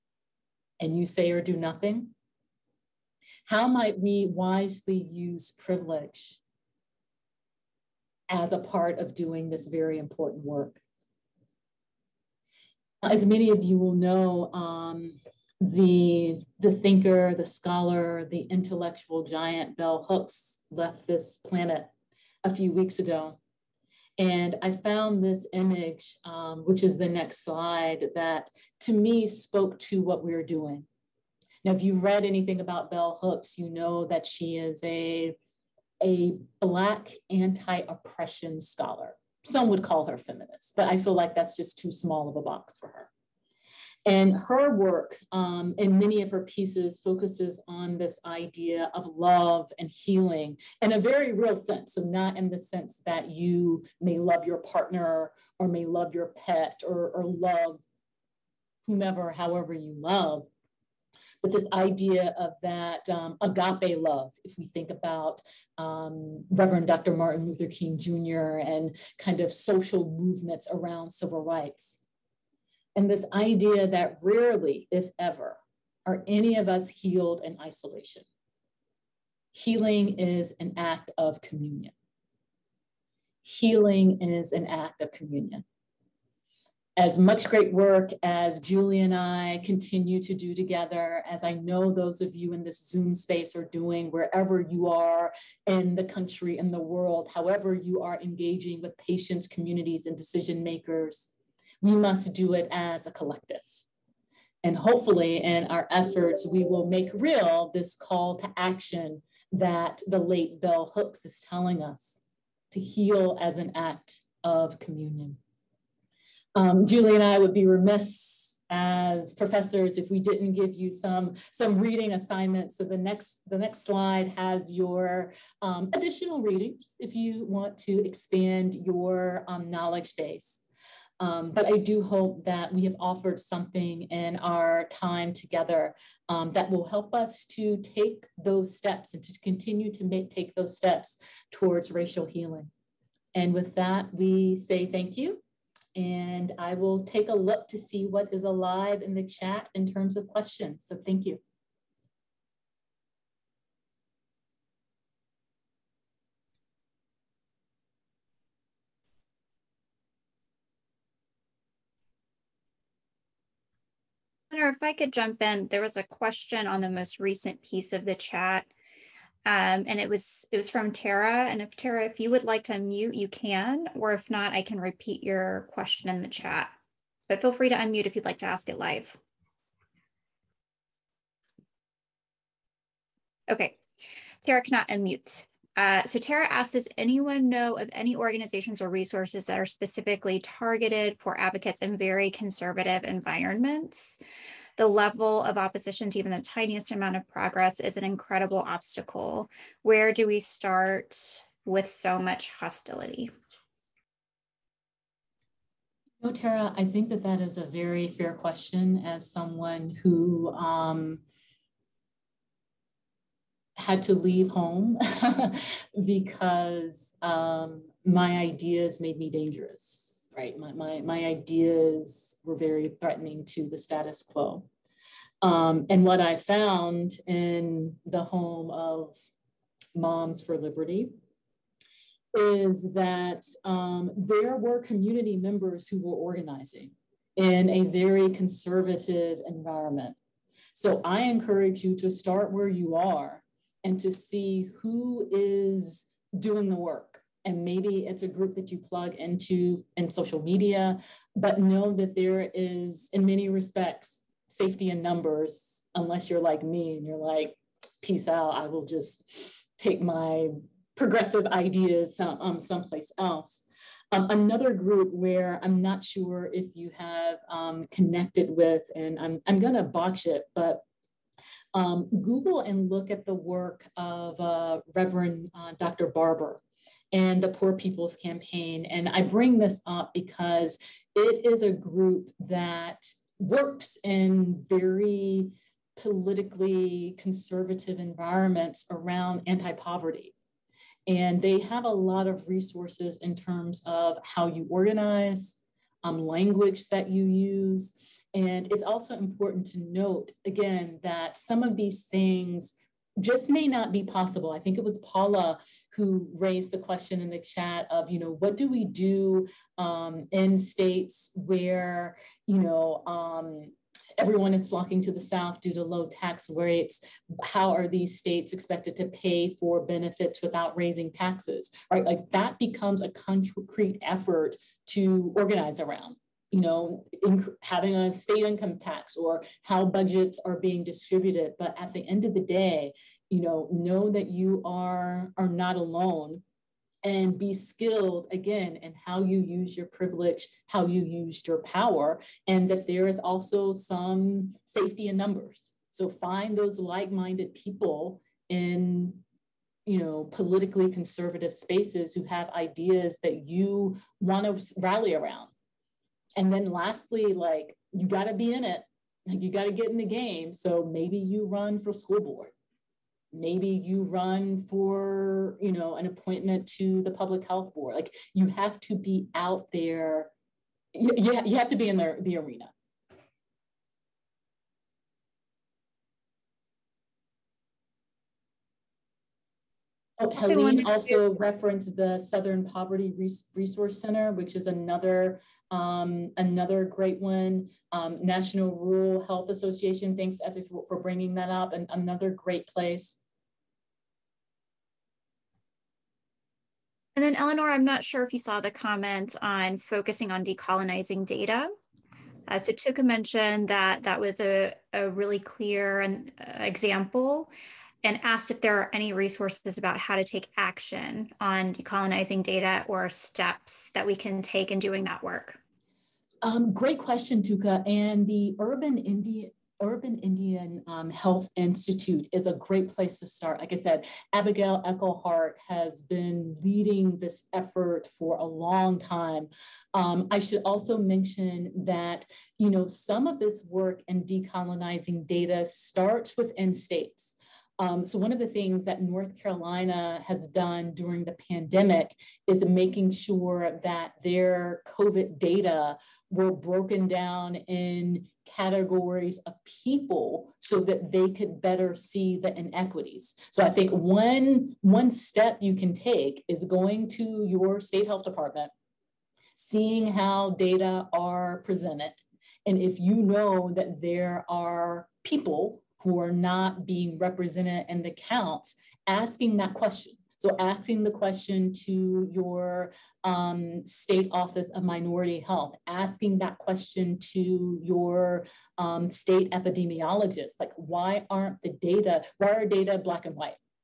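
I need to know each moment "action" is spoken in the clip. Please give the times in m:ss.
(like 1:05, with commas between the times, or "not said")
1:48, 6:50.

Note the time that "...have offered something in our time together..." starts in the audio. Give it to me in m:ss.
2:12.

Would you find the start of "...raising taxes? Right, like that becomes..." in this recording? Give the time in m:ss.
5:20.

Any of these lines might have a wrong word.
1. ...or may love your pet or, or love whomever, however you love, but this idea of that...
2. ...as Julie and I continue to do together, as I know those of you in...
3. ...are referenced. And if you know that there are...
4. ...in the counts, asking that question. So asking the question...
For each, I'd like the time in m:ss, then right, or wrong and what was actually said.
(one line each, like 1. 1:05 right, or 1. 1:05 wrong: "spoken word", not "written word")
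1. 0:55 right
2. 1:28 right
3. 7:41 wrong: "presented", not "referenced"
4. 7:47 right.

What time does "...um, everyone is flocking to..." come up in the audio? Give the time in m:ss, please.
5:13.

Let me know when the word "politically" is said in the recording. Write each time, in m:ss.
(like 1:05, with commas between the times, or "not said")
4:45, 5:50.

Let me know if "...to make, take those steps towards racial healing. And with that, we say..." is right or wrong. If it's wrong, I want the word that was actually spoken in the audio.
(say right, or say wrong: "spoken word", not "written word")
right.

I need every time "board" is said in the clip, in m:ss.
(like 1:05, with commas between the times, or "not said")
6:02, 6:07.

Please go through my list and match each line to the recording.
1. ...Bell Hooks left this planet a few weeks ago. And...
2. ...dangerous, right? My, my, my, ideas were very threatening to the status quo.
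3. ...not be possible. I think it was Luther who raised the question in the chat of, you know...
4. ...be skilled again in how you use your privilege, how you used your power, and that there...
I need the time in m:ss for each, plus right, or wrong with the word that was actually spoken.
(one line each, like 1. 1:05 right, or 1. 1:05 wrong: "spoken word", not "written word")
1. 0:19 right
2. 3:39 right
3. 5:03 wrong: "Paula", not "Luther"
4. 5:37 right.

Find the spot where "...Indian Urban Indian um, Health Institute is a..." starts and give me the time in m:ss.
6:58.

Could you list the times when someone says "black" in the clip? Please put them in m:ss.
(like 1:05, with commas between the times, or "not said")
0:36, 8:02.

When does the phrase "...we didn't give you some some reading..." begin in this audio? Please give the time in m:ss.
2:00.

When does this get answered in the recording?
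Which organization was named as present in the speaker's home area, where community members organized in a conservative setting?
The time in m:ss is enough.
3:49.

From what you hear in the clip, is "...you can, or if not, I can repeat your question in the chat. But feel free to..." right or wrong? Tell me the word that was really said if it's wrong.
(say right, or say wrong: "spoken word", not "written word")
right.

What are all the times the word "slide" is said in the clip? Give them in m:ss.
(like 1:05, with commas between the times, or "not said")
0:27, 2:03.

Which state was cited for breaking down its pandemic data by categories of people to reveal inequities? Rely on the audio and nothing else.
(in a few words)
North Carolina.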